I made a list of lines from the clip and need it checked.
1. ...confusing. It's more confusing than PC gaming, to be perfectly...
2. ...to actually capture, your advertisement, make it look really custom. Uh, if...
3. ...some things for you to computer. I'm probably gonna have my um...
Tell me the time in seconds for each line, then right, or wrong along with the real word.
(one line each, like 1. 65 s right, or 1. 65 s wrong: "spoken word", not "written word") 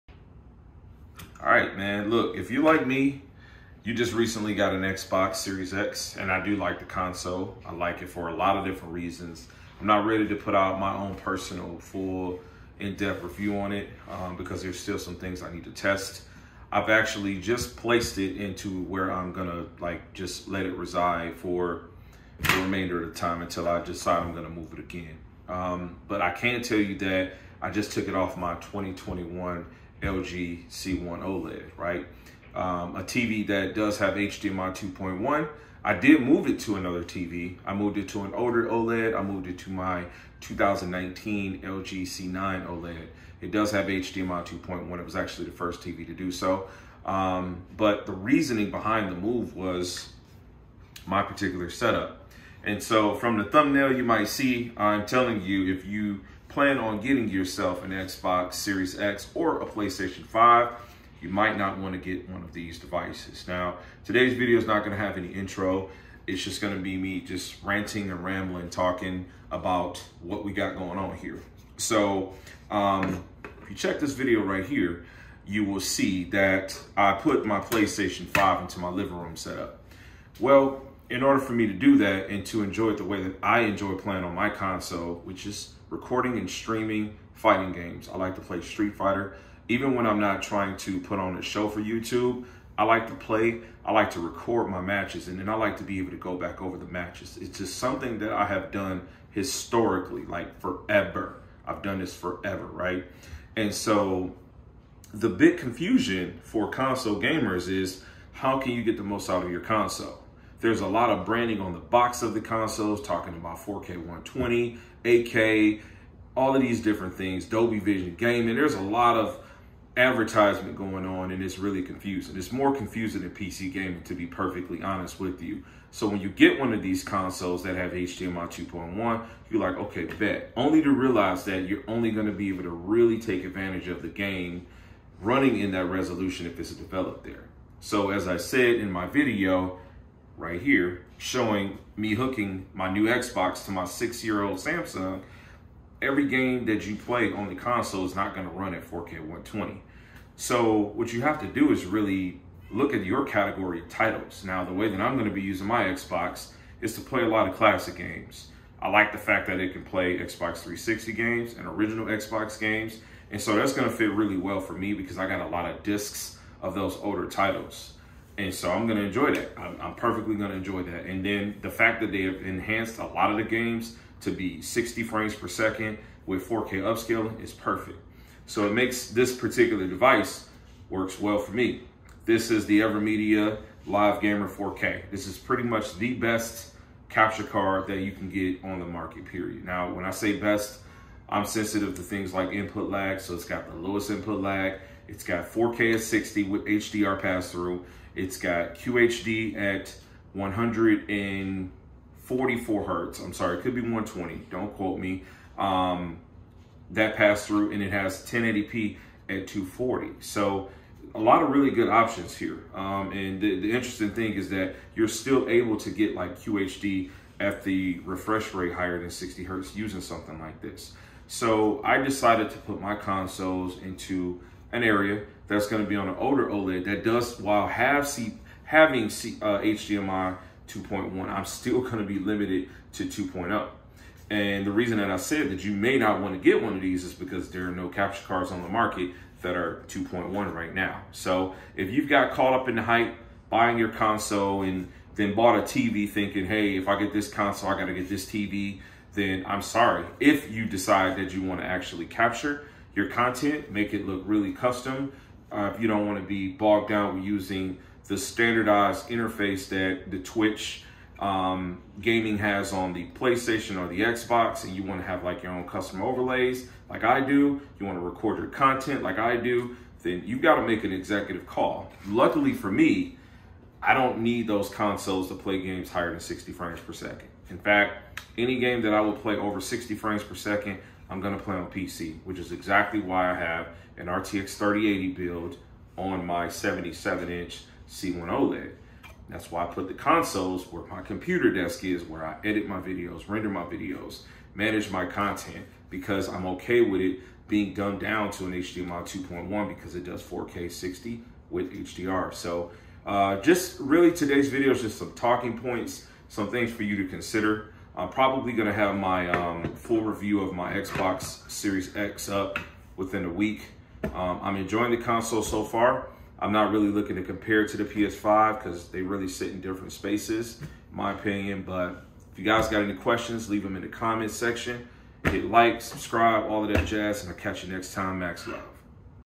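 1. 121 s right
2. 251 s wrong: "content", not "advertisement"
3. 306 s wrong: "consider", not "computer".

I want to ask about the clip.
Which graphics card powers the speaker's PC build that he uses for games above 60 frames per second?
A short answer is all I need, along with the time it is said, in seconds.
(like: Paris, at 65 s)
RTX 3080, at 284 s.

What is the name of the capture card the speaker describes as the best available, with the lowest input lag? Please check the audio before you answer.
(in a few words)
AVerMedia Live Gamer 4K.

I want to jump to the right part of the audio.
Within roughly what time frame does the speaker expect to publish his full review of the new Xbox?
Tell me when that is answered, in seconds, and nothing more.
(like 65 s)
312 s.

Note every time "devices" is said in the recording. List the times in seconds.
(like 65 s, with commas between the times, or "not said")
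62 s, 179 s.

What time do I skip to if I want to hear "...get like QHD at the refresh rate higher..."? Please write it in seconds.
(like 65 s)
215 s.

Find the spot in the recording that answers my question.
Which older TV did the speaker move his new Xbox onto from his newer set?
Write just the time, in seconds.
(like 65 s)
40 s.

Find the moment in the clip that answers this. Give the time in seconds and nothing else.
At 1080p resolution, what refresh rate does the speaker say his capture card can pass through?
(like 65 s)
209 s.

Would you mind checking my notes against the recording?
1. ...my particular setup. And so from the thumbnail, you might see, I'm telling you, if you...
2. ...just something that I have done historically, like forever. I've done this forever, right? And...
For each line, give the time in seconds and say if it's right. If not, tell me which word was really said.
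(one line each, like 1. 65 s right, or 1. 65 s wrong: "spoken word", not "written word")
1. 51 s right
2. 97 s right.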